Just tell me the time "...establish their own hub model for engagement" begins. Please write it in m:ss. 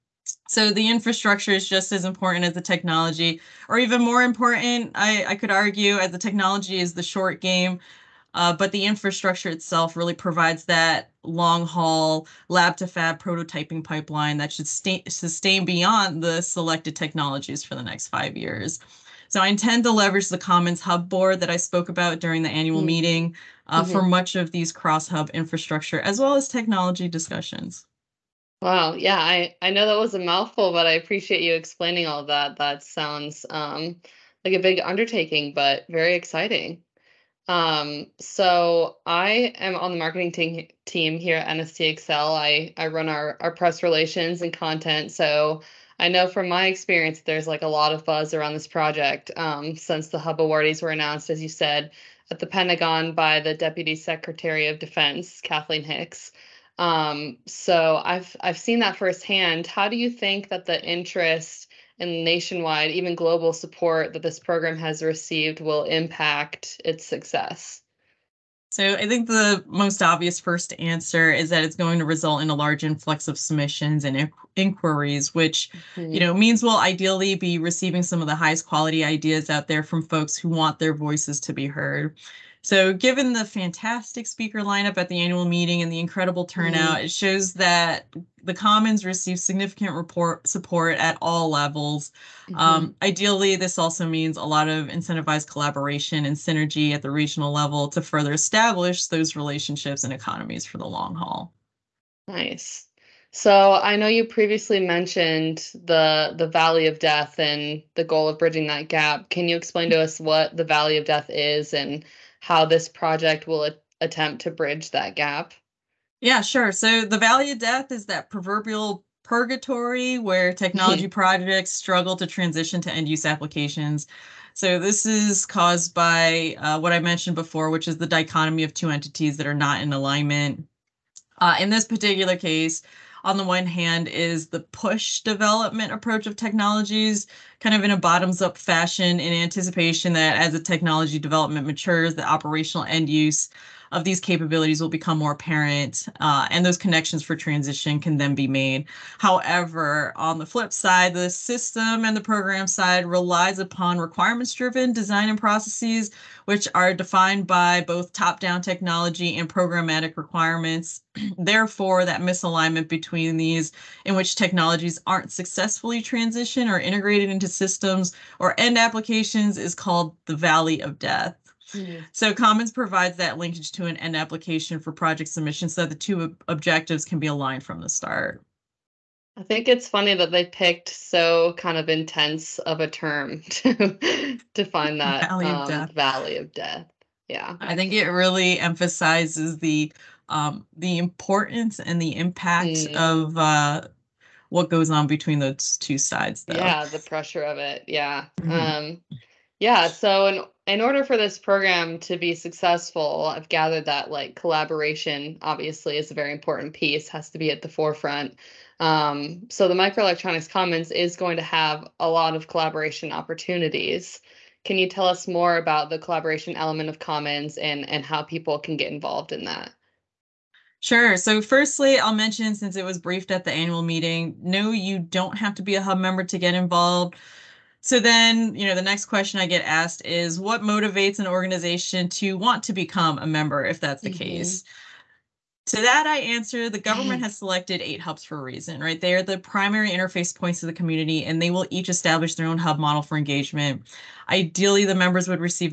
4:01.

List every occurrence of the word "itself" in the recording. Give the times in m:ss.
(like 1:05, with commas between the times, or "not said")
0:09.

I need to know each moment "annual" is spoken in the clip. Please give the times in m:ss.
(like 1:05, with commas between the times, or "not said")
0:22, 1:25, 3:43.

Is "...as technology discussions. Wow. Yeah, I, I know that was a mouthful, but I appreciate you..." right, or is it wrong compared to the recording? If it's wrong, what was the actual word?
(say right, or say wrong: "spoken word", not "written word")
right.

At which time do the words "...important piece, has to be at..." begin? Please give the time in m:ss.
3:26.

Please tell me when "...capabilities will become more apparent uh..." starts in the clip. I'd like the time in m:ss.
2:24.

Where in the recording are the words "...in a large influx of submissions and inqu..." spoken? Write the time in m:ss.
1:12.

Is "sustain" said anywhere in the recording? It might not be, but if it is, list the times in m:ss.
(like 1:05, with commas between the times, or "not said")
0:15.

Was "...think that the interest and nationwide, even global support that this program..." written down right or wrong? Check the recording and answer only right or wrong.
right.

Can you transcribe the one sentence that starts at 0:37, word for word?
Um, so I am on the marketing te- team here at NSTXL.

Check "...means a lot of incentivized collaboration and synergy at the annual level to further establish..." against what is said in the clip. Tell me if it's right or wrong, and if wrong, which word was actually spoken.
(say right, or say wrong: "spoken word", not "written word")
wrong: "regional", not "annual".